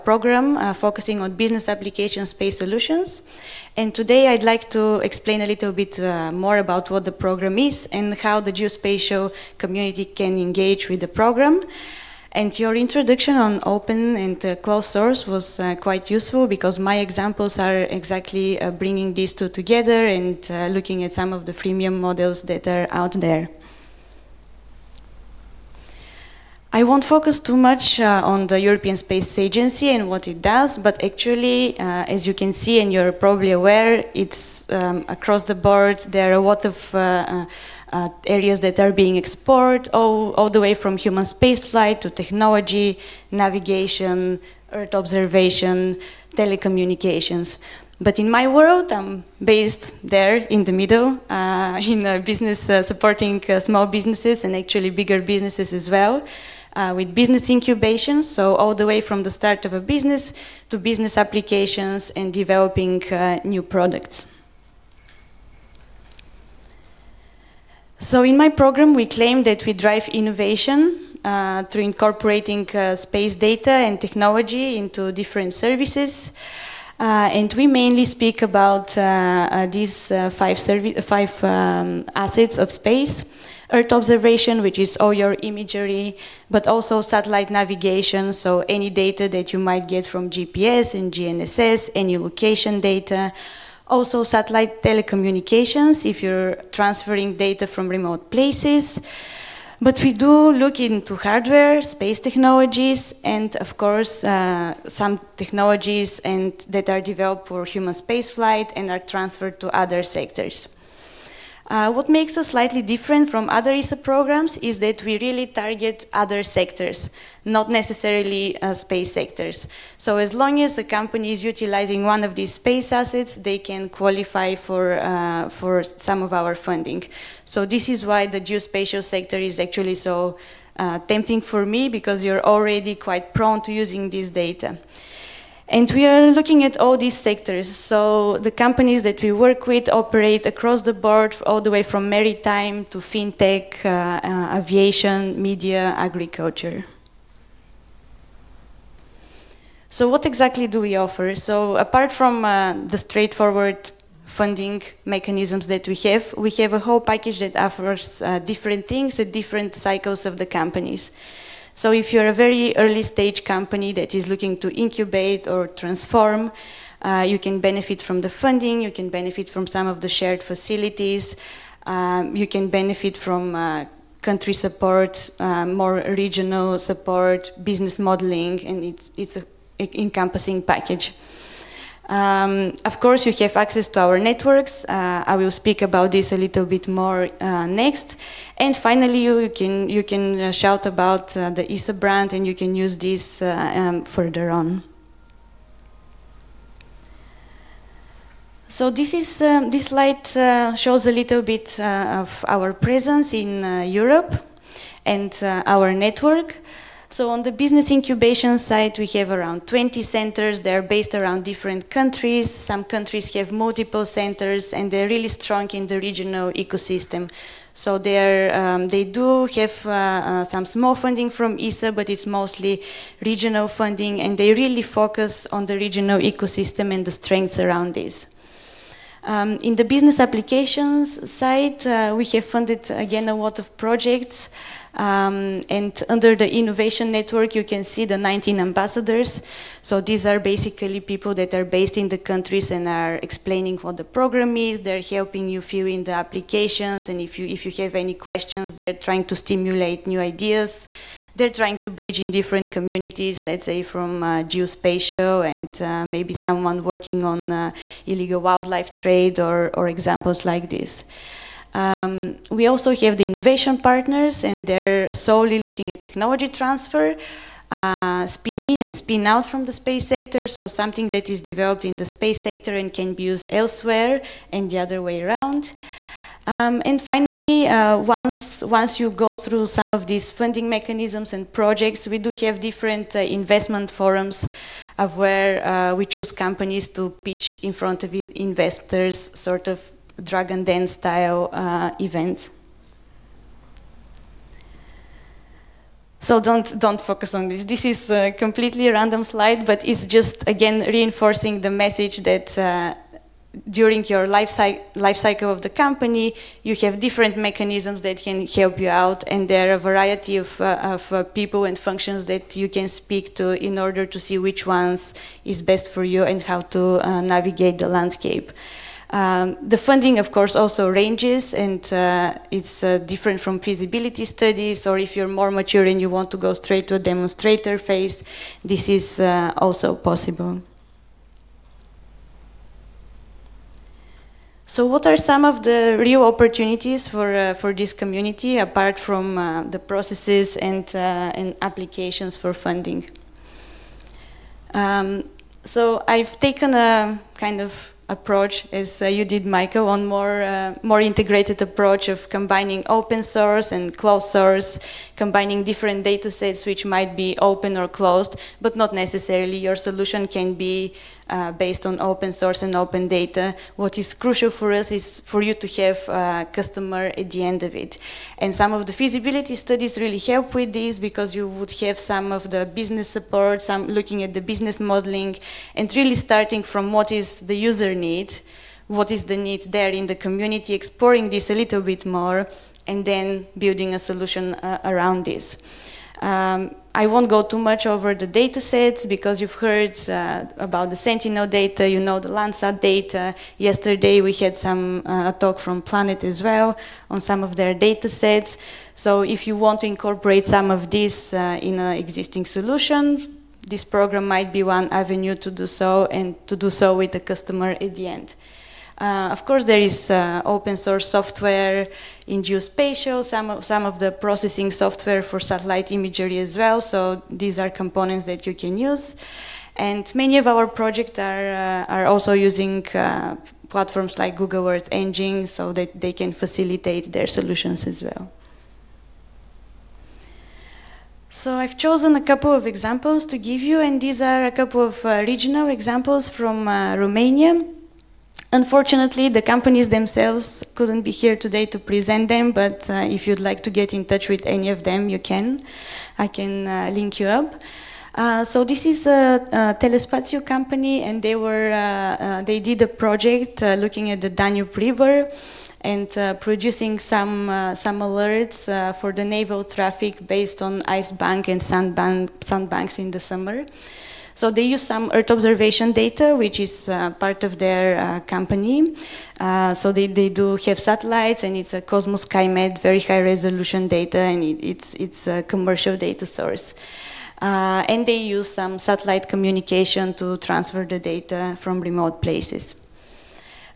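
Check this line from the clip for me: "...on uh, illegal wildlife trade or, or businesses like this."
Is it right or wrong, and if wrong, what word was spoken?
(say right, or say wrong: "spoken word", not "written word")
wrong: "examples", not "businesses".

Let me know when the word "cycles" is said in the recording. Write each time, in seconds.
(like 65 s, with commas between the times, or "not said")
159 s, 305 s.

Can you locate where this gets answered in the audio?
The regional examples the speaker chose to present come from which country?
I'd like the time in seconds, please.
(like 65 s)
436 s.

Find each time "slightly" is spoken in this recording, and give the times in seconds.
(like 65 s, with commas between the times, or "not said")
112 s.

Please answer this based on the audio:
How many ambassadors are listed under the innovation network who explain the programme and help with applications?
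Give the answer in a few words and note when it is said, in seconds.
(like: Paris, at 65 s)
19, at 238 s.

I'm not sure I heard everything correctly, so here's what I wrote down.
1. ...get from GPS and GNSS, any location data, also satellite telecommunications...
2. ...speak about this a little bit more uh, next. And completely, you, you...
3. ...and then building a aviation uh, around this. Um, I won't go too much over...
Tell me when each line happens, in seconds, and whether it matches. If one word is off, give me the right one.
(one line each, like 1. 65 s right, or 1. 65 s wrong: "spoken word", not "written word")
1. 89 s right
2. 185 s wrong: "finally", not "completely"
3. 382 s wrong: "solution", not "aviation".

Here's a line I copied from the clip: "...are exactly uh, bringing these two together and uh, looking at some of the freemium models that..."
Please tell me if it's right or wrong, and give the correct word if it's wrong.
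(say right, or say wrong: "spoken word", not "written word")
right.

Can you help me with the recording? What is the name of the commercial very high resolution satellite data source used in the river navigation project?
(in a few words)
COSMO-SkyMed.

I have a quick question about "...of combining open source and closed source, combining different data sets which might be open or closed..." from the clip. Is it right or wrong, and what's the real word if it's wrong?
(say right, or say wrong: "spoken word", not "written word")
right.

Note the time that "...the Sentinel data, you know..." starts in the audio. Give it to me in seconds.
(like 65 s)
390 s.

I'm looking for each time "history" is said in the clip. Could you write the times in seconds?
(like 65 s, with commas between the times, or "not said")
not said.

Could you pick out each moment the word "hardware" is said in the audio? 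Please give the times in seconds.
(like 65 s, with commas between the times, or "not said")
101 s.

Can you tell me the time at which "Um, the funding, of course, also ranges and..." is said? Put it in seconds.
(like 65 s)
319 s.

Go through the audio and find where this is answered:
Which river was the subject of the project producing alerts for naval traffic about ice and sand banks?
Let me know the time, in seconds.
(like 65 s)
454 s.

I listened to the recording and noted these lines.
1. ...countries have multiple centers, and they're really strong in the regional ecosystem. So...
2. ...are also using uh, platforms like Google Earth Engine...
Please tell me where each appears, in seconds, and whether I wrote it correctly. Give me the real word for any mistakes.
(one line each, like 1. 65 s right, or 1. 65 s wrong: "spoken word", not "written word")
1. 212 s right
2. 421 s right.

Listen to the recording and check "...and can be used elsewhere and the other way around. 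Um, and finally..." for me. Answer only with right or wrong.
right.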